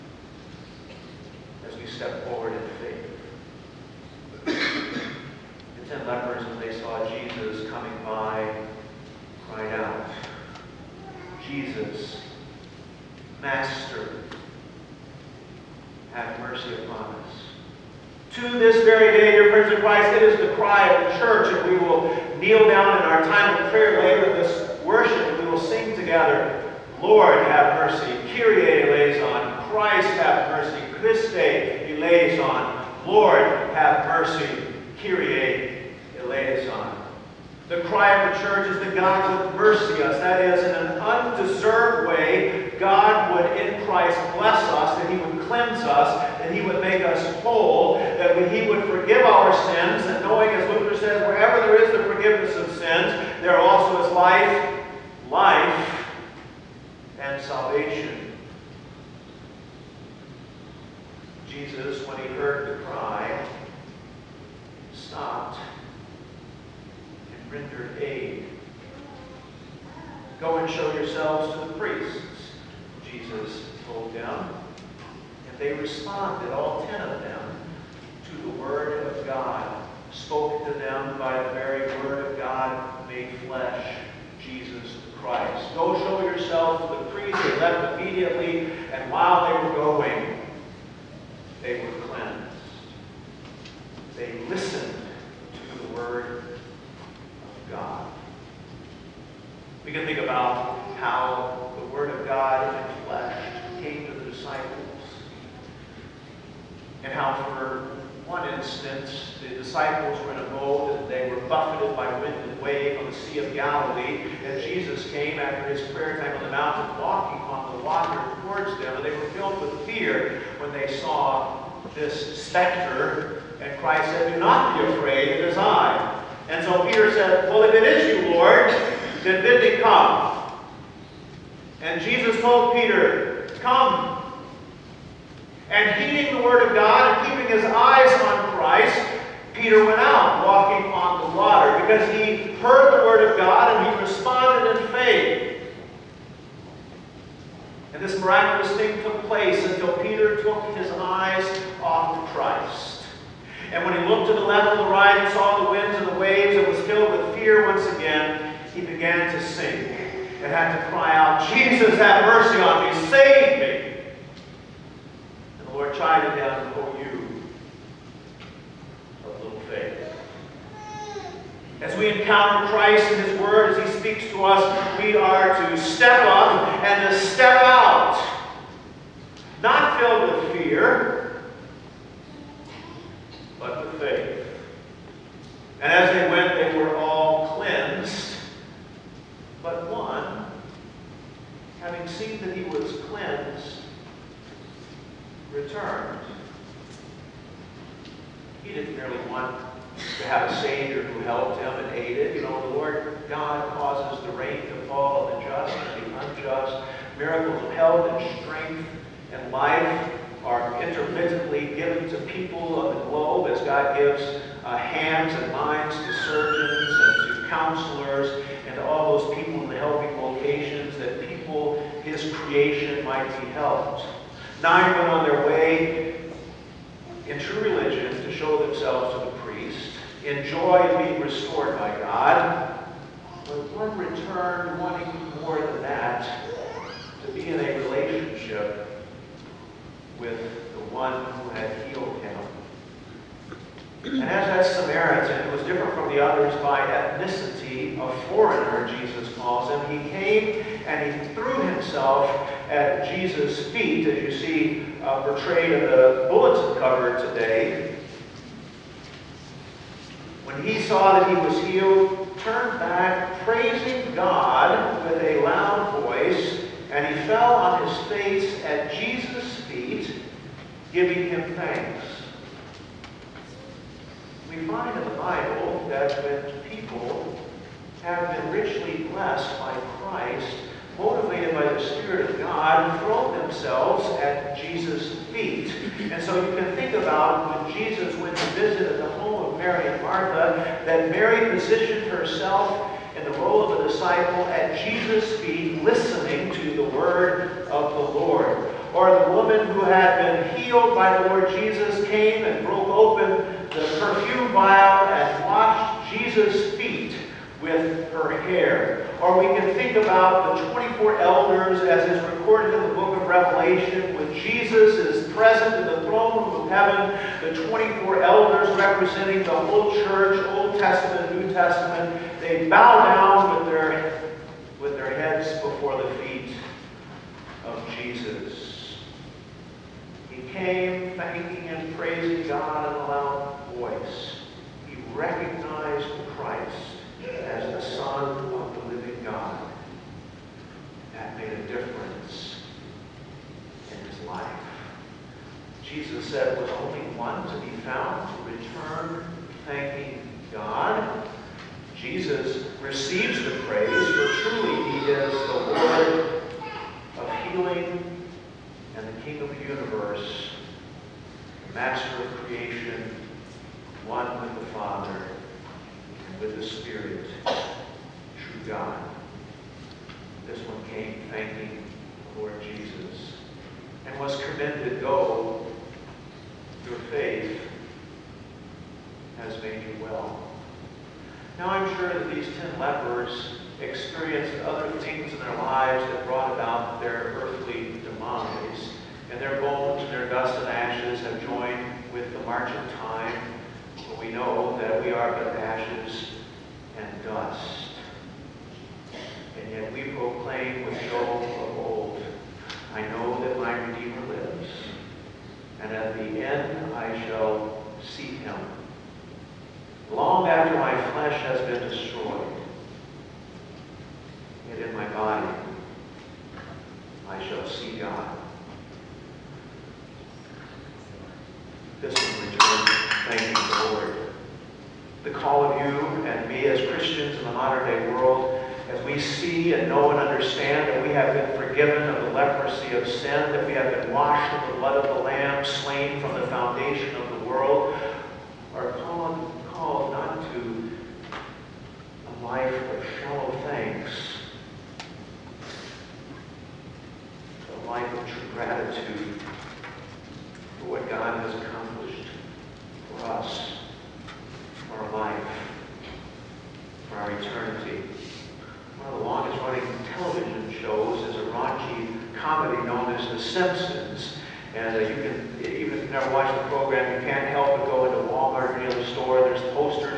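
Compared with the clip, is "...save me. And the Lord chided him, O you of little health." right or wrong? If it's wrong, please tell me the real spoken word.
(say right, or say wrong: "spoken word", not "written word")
wrong: "faith", not "health".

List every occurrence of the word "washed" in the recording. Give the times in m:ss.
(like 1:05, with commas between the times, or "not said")
5:05, 7:14.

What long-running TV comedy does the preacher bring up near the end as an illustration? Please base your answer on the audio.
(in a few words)
The Simpsons.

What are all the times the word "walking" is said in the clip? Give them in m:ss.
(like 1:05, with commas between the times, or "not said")
1:57, 2:20.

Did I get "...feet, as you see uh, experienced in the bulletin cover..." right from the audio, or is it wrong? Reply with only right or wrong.
wrong.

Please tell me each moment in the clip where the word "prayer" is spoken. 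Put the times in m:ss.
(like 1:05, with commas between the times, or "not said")
0:23, 1:55.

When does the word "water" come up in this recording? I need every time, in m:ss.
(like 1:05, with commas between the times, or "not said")
1:57, 2:21.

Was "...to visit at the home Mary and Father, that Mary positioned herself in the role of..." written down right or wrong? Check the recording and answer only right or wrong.
wrong.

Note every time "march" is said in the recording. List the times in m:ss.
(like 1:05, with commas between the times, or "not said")
6:32.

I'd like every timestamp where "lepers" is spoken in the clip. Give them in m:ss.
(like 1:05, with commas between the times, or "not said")
0:06, 6:22.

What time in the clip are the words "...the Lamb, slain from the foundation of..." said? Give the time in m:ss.
7:15.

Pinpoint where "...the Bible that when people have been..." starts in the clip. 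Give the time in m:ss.
4:35.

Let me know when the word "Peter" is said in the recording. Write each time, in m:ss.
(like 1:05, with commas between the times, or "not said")
2:06, 2:12, 2:19, 2:29.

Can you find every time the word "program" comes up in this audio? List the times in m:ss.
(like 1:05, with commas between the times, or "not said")
7:46.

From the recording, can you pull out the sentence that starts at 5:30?
He came thanking and praising God in a loud voice.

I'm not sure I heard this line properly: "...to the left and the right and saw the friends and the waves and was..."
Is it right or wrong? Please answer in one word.
wrong.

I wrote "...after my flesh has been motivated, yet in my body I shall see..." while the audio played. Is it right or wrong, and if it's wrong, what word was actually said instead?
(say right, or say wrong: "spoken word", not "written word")
wrong: "destroyed", not "motivated".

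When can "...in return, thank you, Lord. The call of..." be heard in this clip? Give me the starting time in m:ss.
7:02.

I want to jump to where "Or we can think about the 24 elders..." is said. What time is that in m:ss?
5:09.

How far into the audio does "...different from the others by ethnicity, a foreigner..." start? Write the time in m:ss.
4:05.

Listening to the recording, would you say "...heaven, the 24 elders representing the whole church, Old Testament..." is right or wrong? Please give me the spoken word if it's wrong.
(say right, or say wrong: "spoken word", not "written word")
right.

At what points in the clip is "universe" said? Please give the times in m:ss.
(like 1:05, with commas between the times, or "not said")
5:59.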